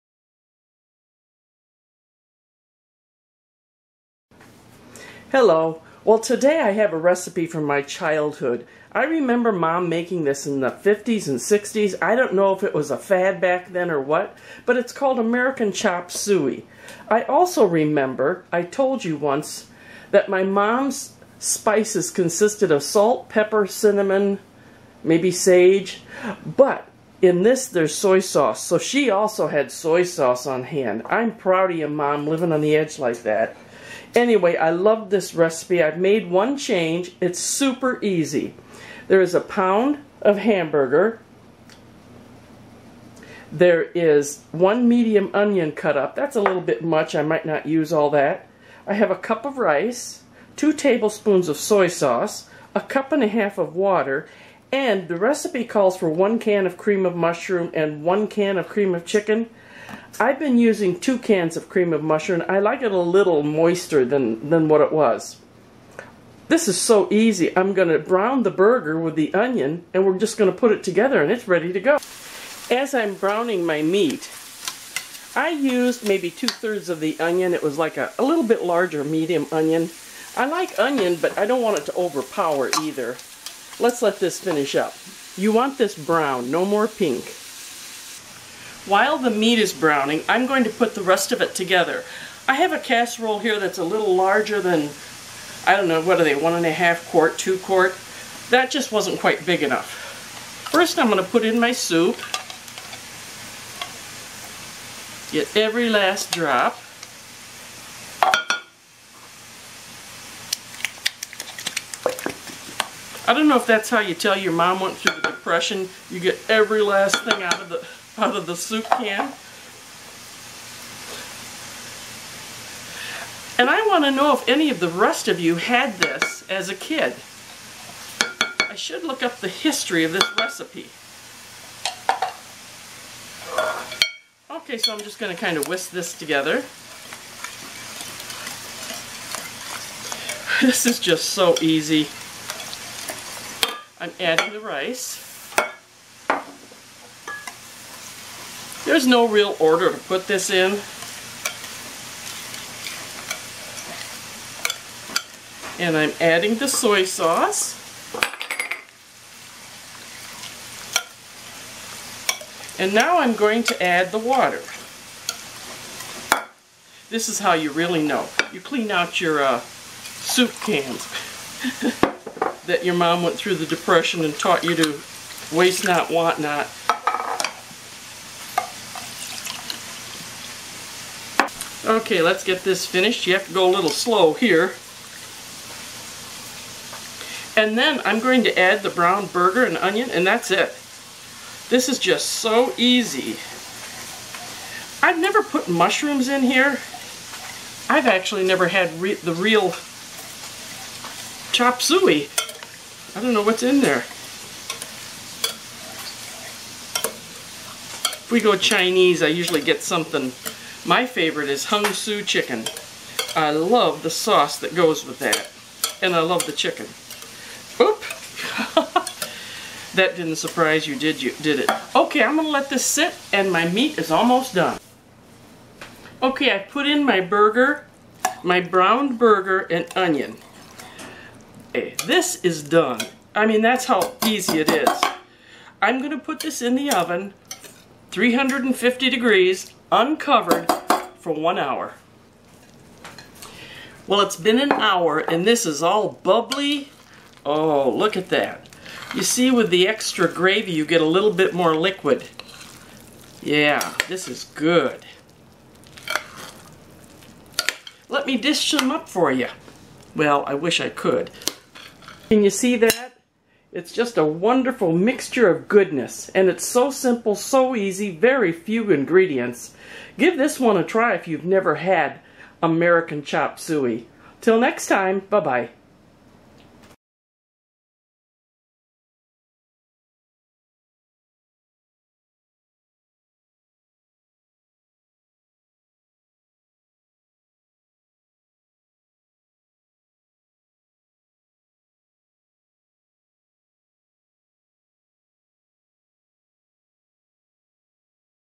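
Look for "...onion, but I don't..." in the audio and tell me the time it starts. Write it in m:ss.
1:20.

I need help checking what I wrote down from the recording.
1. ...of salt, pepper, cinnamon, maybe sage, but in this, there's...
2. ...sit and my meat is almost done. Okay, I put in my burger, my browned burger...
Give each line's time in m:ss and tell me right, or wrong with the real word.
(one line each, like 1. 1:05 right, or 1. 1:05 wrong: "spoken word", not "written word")
1. 0:22 right
2. 3:42 right.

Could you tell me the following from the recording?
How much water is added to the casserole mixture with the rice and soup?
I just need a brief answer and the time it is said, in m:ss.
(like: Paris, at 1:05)
1.5 cups, at 0:52.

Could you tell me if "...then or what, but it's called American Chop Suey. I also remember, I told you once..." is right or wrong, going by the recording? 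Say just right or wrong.
right.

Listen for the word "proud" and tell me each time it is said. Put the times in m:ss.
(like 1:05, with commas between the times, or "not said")
0:31.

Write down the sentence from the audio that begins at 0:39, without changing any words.
There is a pound of hamburger.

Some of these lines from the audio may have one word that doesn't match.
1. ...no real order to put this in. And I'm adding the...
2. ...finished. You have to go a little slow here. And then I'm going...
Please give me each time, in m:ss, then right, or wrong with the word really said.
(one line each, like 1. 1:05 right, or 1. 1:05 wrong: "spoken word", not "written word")
1. 2:29 right
2. 3:02 right.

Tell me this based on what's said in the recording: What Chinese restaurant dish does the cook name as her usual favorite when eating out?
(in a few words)
Hung Su chicken.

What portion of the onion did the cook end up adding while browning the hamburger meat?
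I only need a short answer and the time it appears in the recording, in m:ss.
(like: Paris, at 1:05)
two-thirds, at 1:16.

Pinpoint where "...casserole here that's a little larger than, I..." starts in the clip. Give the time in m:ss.
1:32.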